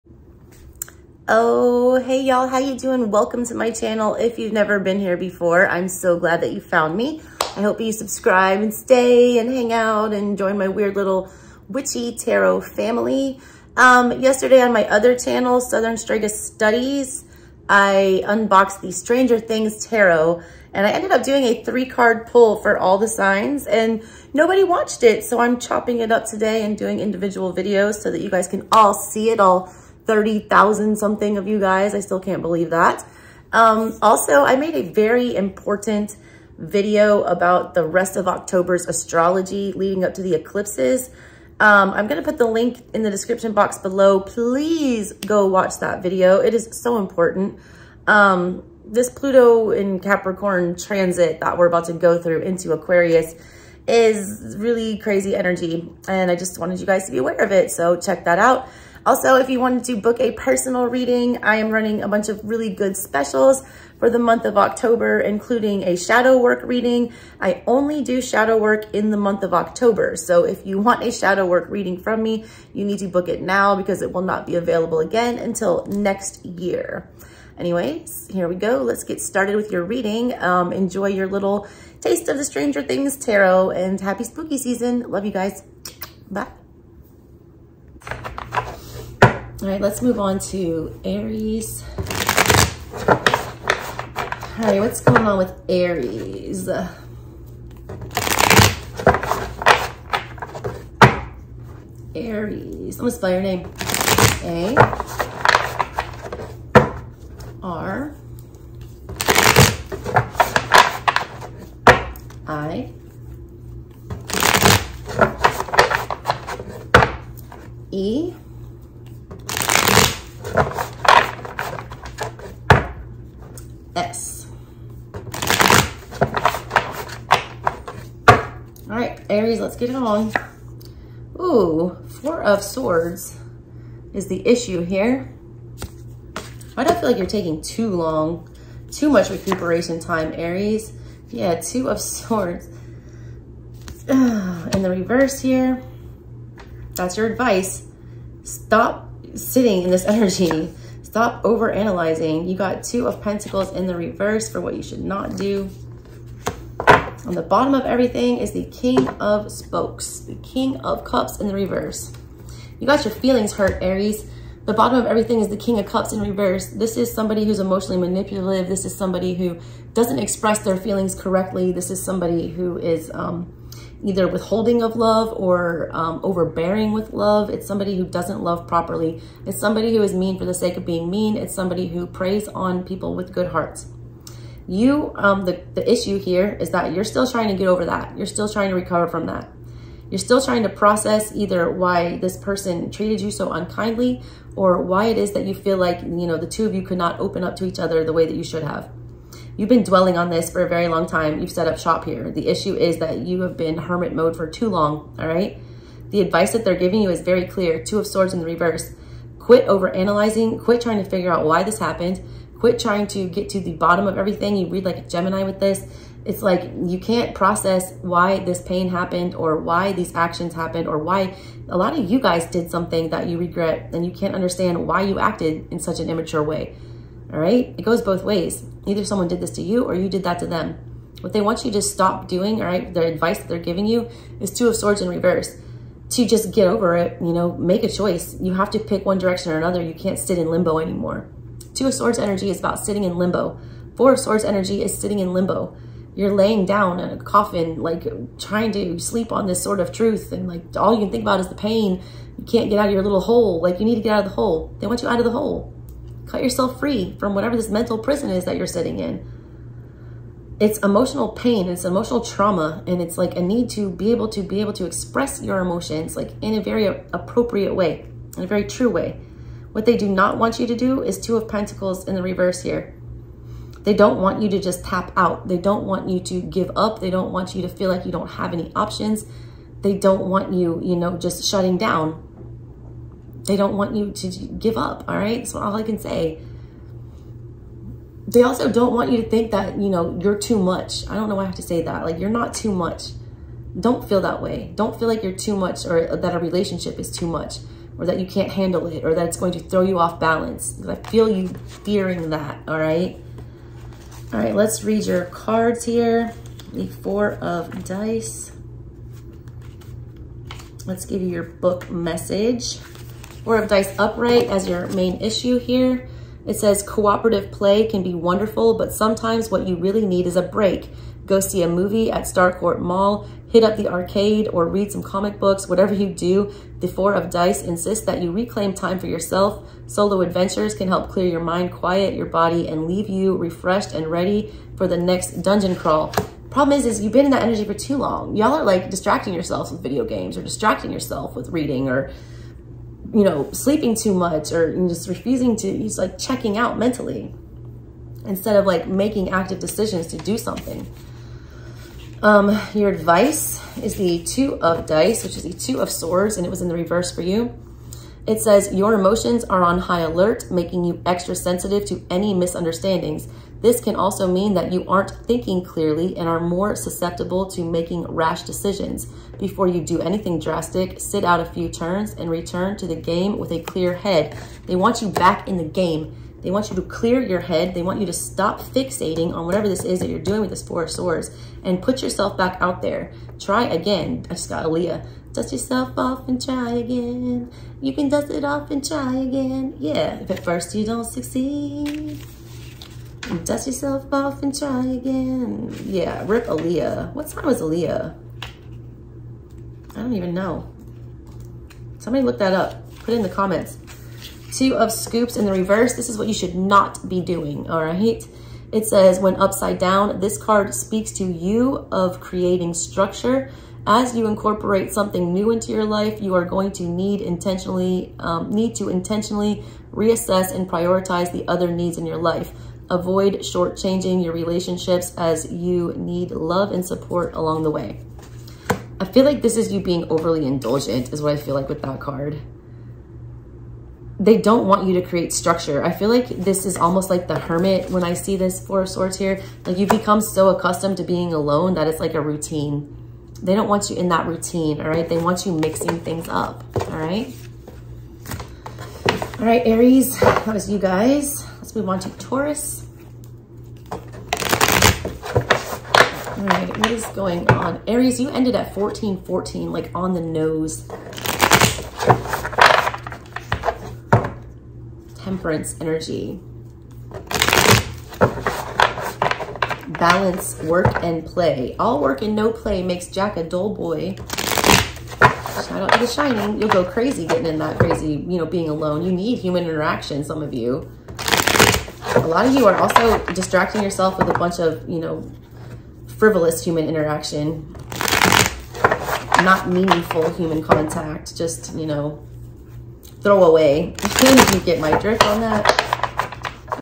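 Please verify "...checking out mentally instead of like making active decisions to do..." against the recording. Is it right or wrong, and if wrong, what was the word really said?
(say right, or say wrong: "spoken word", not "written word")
right.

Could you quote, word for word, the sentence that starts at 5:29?
Solo adventures can help clear your mind, quiet your body, and leave you refreshed and ready for the next dungeon crawl.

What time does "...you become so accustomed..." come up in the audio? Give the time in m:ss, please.
7:19.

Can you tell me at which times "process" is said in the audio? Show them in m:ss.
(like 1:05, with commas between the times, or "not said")
3:10, 3:37.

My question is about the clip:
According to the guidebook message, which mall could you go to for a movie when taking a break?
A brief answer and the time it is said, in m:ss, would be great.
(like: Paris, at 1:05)
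Starcourt Mall, at 5:22.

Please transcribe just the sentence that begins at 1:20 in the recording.
Um, enjoy your little taste of the Stranger Things tarot and happy spooky season.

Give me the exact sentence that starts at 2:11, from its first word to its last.
Ooh, Four of Swords is the issue here.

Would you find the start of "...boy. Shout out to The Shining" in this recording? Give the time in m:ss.
7:53.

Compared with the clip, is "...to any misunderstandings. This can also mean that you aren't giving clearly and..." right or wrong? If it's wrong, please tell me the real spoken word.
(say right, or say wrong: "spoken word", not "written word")
wrong: "thinking", not "giving".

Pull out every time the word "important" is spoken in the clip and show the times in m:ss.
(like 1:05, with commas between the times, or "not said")
0:35, 0:46.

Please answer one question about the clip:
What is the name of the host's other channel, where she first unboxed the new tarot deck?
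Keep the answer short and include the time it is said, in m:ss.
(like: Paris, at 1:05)
Southern Strega Studies, at 0:15.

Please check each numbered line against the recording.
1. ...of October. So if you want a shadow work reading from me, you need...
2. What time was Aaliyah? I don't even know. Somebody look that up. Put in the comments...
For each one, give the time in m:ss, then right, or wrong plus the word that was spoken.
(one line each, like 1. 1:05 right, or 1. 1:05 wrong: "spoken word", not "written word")
1. 1:09 right
2. 6:37 right.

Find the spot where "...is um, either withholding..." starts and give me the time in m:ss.
2:52.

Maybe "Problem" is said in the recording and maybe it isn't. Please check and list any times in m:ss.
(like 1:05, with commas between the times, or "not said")
5:36.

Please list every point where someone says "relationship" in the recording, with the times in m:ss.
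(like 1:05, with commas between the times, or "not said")
4:56, 7:04.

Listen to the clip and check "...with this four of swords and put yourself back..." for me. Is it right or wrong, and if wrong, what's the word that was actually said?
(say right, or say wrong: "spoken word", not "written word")
right.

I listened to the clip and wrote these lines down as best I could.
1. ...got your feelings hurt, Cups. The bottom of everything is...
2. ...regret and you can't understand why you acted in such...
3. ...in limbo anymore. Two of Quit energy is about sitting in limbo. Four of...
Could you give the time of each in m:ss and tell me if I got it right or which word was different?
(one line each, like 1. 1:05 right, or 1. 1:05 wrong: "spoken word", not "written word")
1. 2:42 wrong: "Aries", not "Cups"
2. 3:43 right
3. 4:00 wrong: "Swords", not "Quit".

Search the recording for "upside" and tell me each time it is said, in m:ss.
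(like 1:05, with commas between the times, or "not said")
6:49.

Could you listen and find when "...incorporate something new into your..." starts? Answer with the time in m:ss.
6:54.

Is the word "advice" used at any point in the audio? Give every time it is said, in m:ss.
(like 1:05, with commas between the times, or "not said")
2:27, 3:26, 3:53, 5:52.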